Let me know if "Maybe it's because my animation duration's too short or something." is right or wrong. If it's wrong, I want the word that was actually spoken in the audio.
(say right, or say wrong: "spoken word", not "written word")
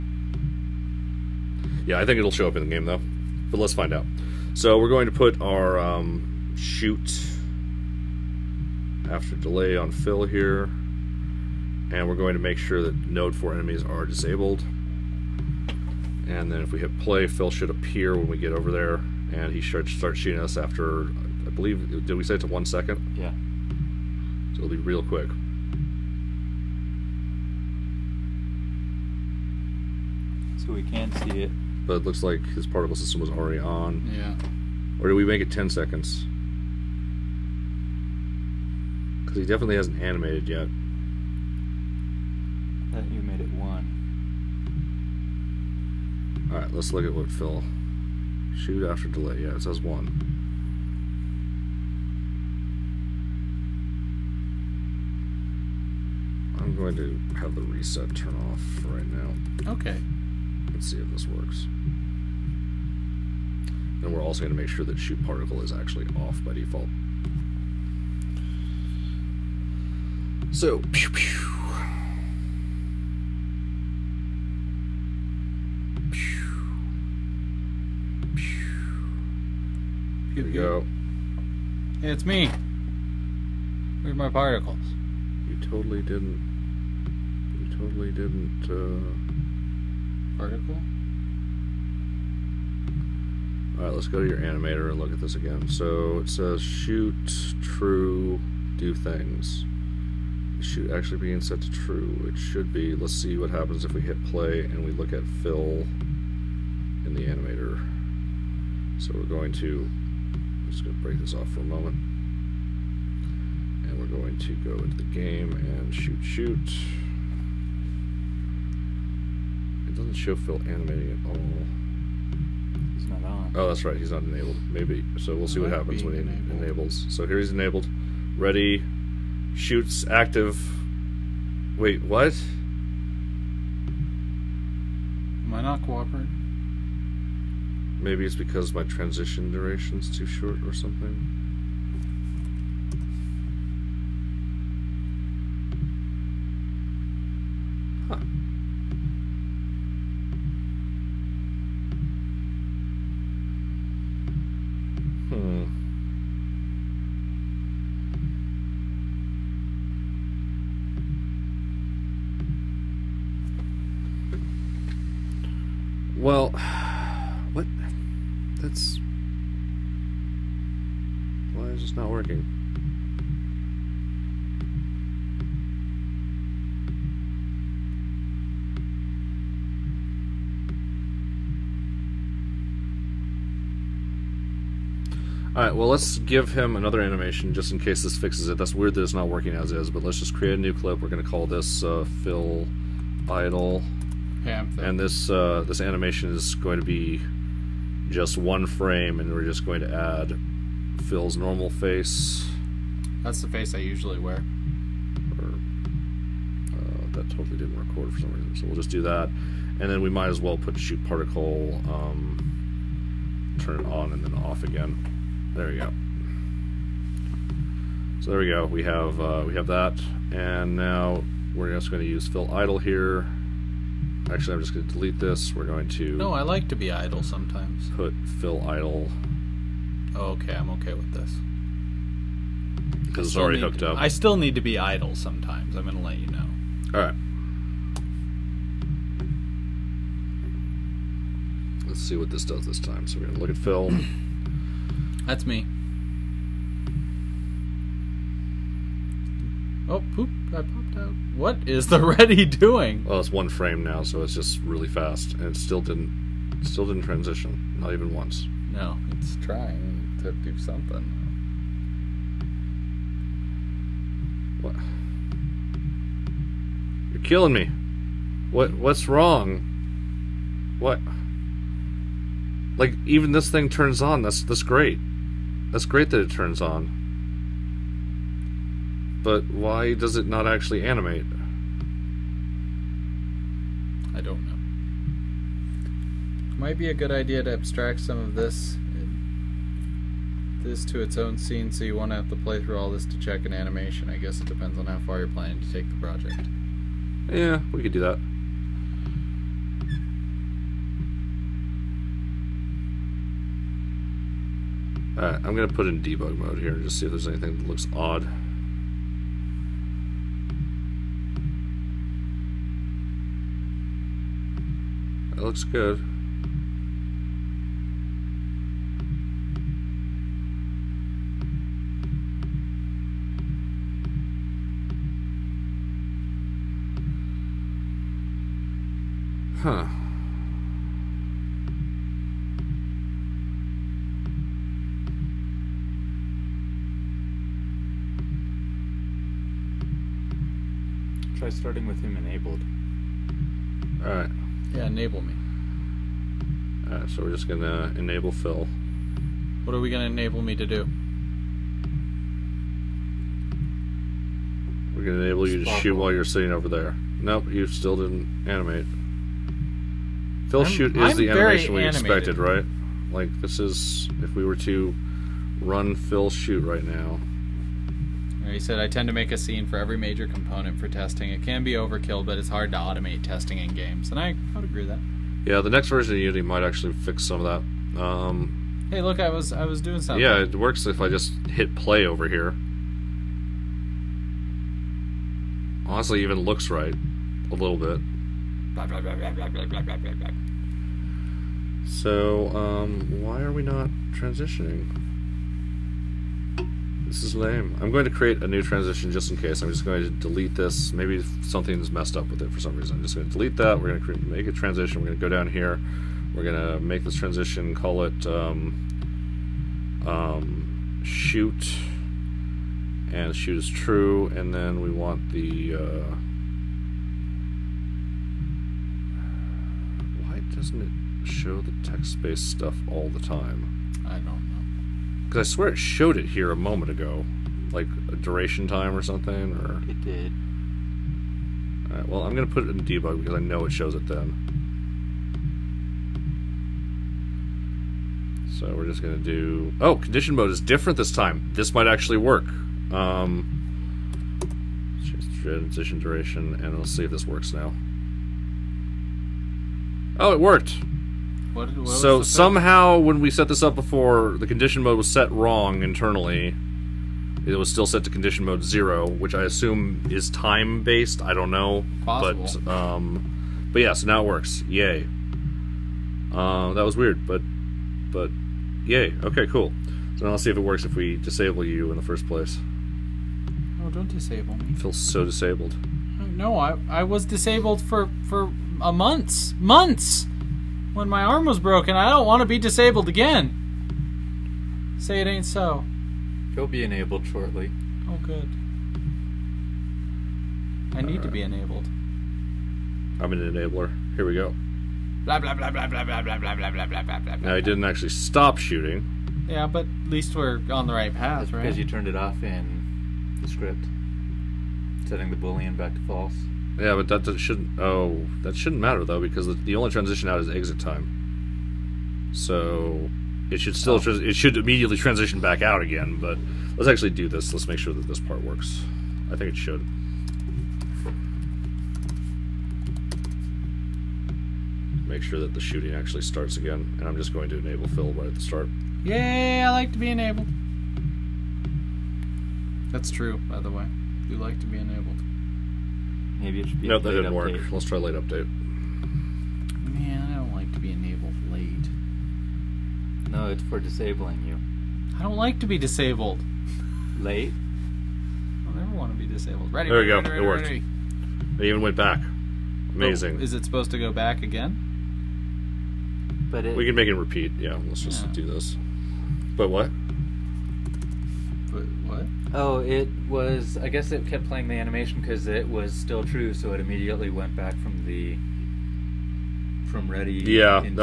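wrong: "transition", not "animation".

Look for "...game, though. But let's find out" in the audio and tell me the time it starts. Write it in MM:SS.
00:02.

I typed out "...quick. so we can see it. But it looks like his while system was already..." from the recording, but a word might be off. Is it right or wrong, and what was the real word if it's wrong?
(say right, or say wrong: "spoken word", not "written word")
wrong: "particle", not "while".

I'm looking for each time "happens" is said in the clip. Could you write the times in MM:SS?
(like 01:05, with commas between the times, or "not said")
01:43, 02:05.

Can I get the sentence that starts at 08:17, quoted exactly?
Now he didn't actually stop shooting.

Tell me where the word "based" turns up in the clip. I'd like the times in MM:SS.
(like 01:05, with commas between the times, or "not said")
07:01, 07:40.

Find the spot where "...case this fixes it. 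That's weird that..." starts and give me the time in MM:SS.
03:07.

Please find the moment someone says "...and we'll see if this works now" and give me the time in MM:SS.
07:26.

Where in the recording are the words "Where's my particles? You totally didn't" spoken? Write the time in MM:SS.
01:24.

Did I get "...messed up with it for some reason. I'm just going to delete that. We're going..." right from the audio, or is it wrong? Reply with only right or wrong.
right.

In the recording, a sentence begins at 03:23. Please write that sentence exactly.
That's the face I usually wear.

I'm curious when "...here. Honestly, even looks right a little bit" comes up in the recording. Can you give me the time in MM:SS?
06:22.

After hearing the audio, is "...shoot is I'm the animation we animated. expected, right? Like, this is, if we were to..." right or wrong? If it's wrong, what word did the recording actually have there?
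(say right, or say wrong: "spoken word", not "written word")
right.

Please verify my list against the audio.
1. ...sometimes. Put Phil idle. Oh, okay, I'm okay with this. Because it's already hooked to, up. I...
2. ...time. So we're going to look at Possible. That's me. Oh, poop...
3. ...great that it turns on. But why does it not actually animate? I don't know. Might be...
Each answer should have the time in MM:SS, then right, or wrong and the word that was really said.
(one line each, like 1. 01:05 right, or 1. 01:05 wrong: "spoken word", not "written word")
1. 03:47 right
2. 04:02 wrong: "Phil", not "Possible"
3. 04:35 right.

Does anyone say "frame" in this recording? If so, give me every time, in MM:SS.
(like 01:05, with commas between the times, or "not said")
03:18, 04:13.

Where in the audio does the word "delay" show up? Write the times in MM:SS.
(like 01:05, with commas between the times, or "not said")
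00:09, 00:49.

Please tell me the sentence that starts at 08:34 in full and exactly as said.
it should immediately transition back out again.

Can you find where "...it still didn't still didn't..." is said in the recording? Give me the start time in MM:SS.
04:15.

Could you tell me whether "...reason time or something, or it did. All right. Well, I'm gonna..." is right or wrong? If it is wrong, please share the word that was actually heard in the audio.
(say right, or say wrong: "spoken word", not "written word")
wrong: "duration", not "reason".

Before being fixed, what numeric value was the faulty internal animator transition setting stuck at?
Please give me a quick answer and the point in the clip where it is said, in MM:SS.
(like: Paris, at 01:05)
0, at 07:38.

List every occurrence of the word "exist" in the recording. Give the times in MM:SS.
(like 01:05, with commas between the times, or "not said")
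not said.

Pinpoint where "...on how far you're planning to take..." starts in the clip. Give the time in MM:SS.
04:54.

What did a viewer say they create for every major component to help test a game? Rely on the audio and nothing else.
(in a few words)
a scene.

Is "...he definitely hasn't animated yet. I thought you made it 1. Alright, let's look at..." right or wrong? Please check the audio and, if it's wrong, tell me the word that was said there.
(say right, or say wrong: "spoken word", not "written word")
right.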